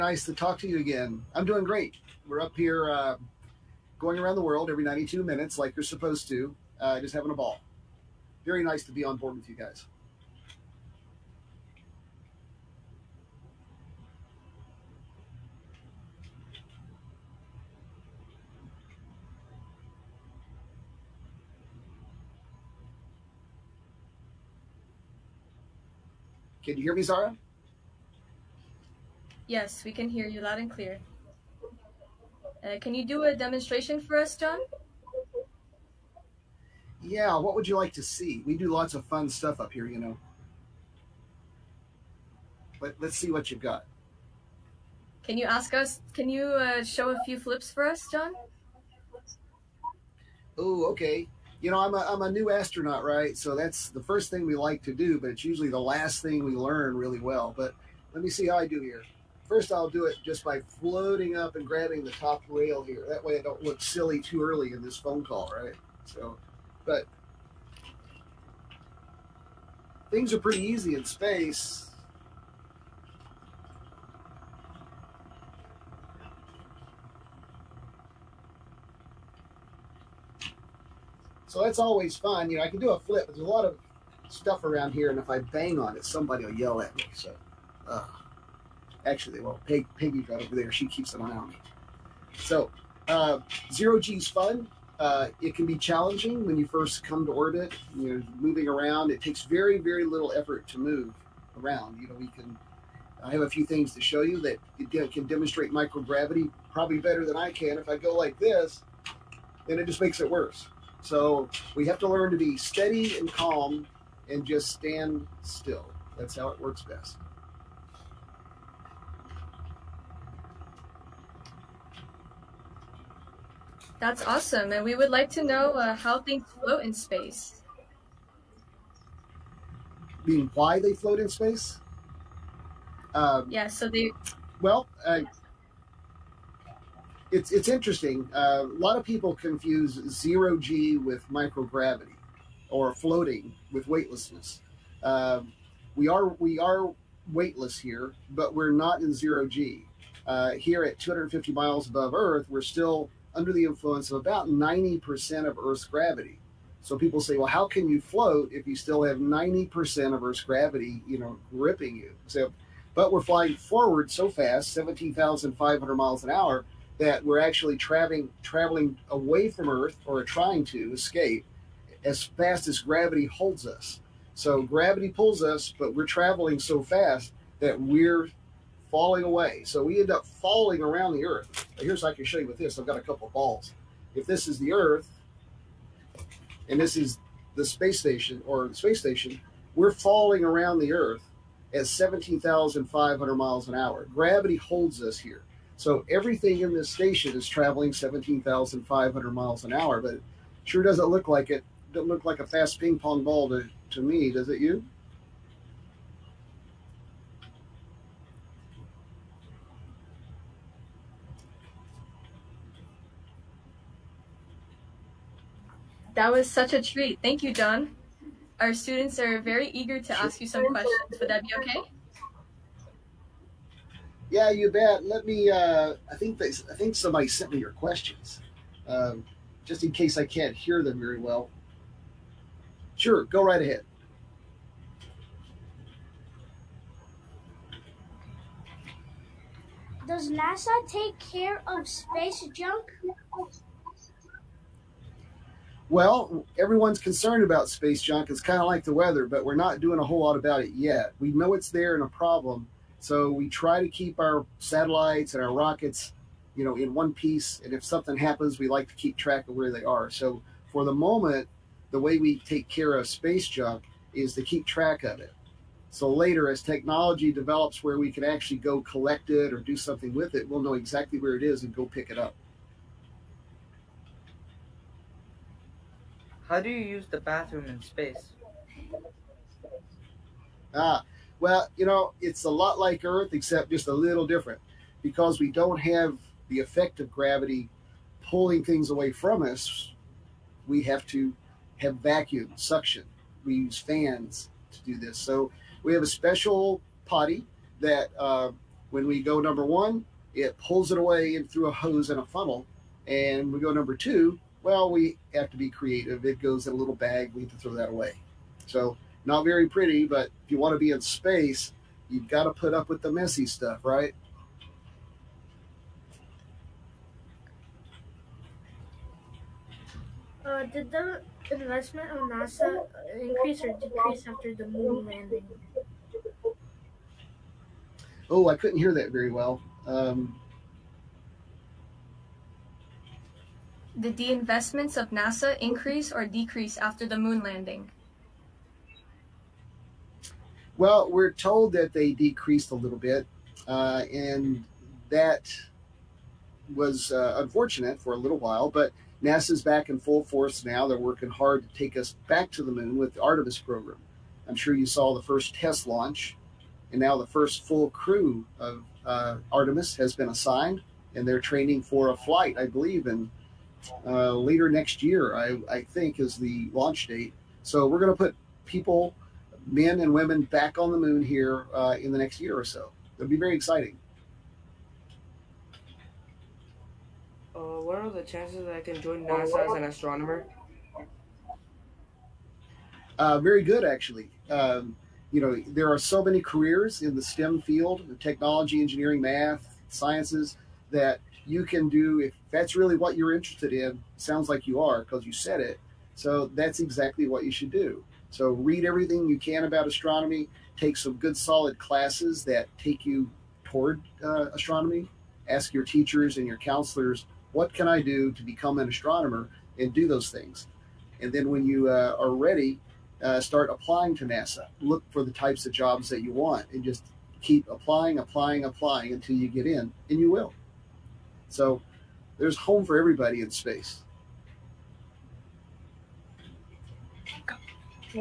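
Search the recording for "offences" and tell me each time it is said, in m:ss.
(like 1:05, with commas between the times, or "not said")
not said.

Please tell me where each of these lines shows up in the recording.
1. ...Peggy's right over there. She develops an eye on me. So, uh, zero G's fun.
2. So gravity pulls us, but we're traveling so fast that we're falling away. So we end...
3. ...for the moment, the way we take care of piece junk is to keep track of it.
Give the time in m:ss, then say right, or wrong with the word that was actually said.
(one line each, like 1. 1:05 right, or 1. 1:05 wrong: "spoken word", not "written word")
1. 1:29 wrong: "keeps", not "develops"
2. 2:54 right
3. 4:20 wrong: "space", not "piece".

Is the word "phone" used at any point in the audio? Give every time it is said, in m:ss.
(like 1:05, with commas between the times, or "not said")
1:04.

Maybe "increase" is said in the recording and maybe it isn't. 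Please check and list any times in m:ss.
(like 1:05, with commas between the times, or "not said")
5:23, 5:35.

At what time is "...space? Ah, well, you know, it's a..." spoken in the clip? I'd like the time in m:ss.
4:37.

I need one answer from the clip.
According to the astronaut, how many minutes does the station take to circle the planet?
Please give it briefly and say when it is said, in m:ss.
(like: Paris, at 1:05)
92 minutes, at 0:04.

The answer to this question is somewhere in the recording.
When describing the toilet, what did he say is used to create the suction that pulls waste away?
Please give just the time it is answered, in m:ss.
4:53.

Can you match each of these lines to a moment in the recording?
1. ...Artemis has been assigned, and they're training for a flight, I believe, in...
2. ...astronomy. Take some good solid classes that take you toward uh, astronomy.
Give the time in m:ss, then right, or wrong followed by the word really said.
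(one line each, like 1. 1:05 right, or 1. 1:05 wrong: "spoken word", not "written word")
1. 5:59 right
2. 6:39 right.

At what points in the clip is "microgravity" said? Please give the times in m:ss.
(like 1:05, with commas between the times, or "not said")
1:45, 2:21.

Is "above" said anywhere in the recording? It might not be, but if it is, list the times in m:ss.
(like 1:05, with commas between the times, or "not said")
2:31.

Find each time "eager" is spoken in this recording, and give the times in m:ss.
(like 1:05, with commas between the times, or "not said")
3:39.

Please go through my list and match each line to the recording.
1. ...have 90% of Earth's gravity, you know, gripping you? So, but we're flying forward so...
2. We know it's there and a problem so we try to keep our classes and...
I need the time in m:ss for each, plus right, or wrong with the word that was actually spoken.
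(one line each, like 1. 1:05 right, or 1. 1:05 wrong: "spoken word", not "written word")
1. 2:39 right
2. 4:11 wrong: "satellites", not "classes".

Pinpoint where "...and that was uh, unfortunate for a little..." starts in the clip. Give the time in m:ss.
5:44.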